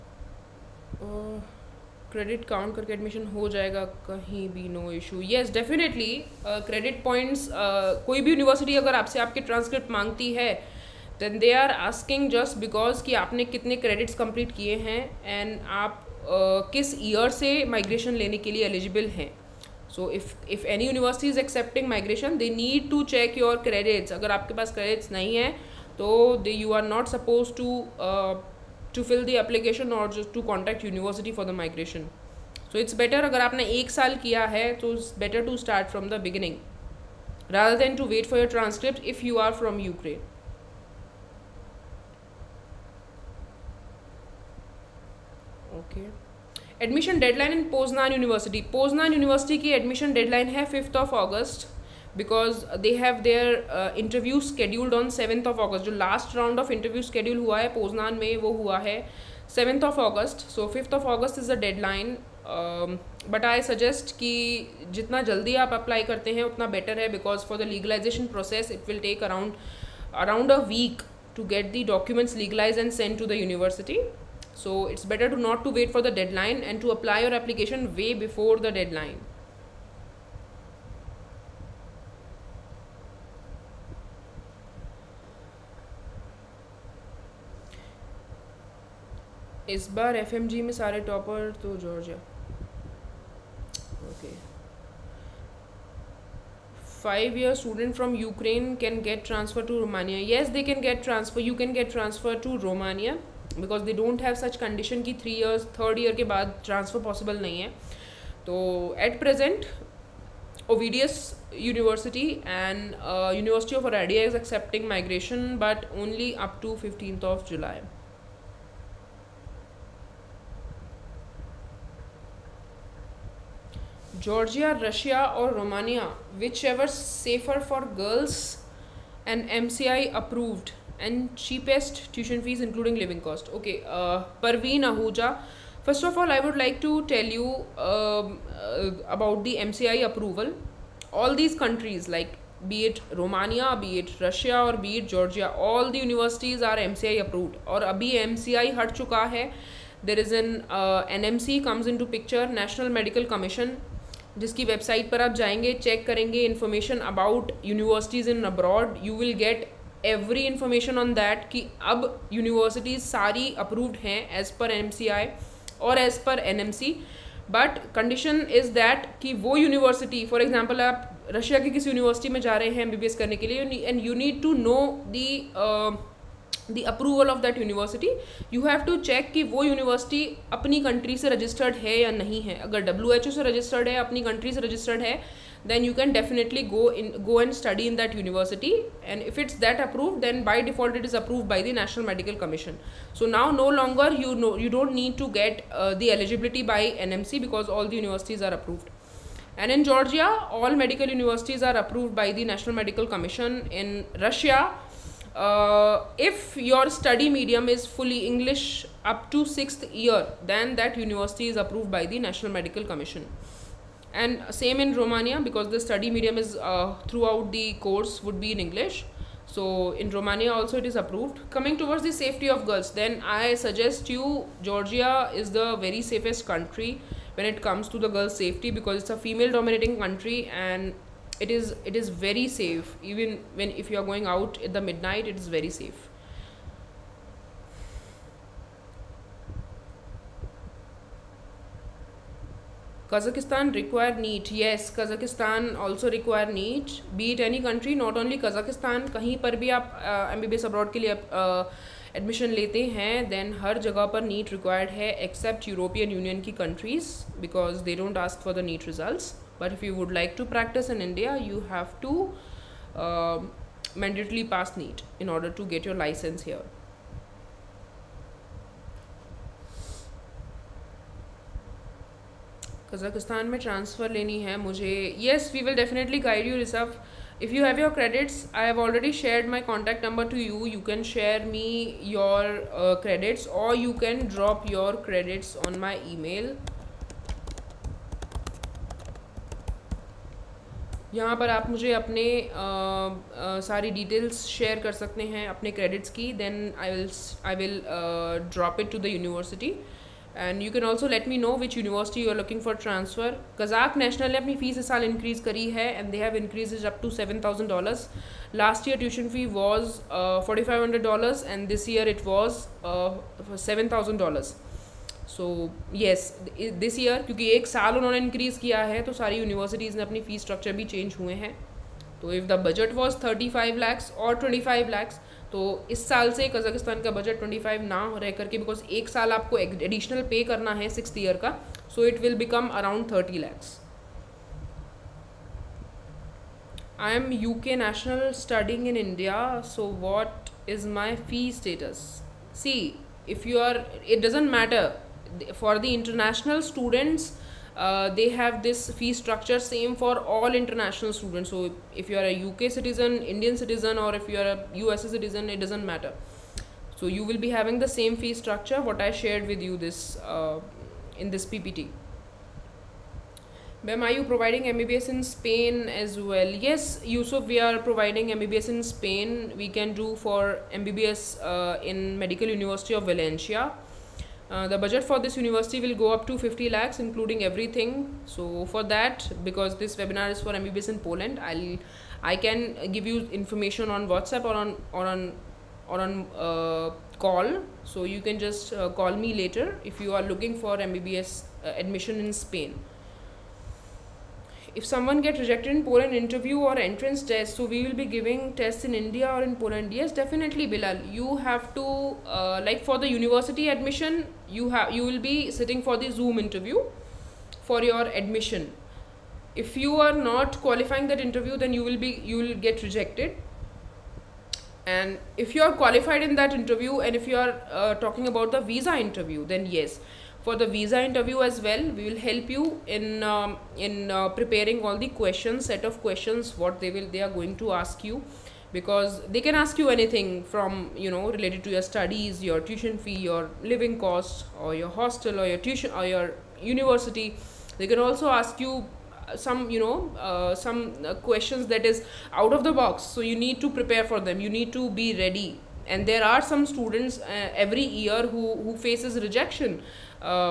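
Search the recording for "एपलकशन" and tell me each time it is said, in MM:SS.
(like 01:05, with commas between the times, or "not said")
00:29, 01:17.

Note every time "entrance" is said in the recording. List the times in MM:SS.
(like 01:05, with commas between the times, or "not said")
06:36.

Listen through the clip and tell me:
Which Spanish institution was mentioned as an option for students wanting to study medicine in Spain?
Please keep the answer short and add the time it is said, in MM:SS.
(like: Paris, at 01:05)
Medical University of Valencia, at 06:12.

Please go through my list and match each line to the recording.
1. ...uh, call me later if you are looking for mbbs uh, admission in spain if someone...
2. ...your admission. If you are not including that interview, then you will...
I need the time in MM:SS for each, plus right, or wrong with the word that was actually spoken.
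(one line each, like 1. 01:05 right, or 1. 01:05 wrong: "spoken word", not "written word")
1. 06:28 right
2. 06:47 wrong: "qualifying", not "including".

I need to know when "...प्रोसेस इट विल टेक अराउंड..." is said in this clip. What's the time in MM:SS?
01:08.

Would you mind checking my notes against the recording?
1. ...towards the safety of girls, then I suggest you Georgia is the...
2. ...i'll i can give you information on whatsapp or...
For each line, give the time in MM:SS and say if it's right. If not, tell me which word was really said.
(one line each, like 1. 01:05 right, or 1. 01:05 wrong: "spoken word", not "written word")
1. 03:41 right
2. 06:21 right.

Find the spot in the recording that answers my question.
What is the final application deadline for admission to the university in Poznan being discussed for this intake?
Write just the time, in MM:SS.
01:00.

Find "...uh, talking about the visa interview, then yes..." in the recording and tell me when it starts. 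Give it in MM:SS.
06:57.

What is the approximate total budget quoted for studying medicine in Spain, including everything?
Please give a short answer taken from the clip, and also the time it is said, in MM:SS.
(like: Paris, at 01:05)
50 lakhs, at 06:16.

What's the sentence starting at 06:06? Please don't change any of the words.
Yes, Yusuf, we are providing MBBS in Spain.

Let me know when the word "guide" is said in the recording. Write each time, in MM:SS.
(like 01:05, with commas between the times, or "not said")
04:36.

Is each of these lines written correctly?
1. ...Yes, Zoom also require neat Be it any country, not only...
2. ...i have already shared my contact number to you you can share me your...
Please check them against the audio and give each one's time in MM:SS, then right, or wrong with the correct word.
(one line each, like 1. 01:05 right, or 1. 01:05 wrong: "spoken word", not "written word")
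1. 04:04 wrong: "Kazakhstan", not "Zoom"
2. 04:38 right.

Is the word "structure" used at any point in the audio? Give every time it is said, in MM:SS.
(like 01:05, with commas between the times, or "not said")
05:49, 05:58.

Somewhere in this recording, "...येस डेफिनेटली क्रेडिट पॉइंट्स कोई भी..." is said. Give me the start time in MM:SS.
00:05.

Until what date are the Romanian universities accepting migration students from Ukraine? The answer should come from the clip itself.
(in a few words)
15 July.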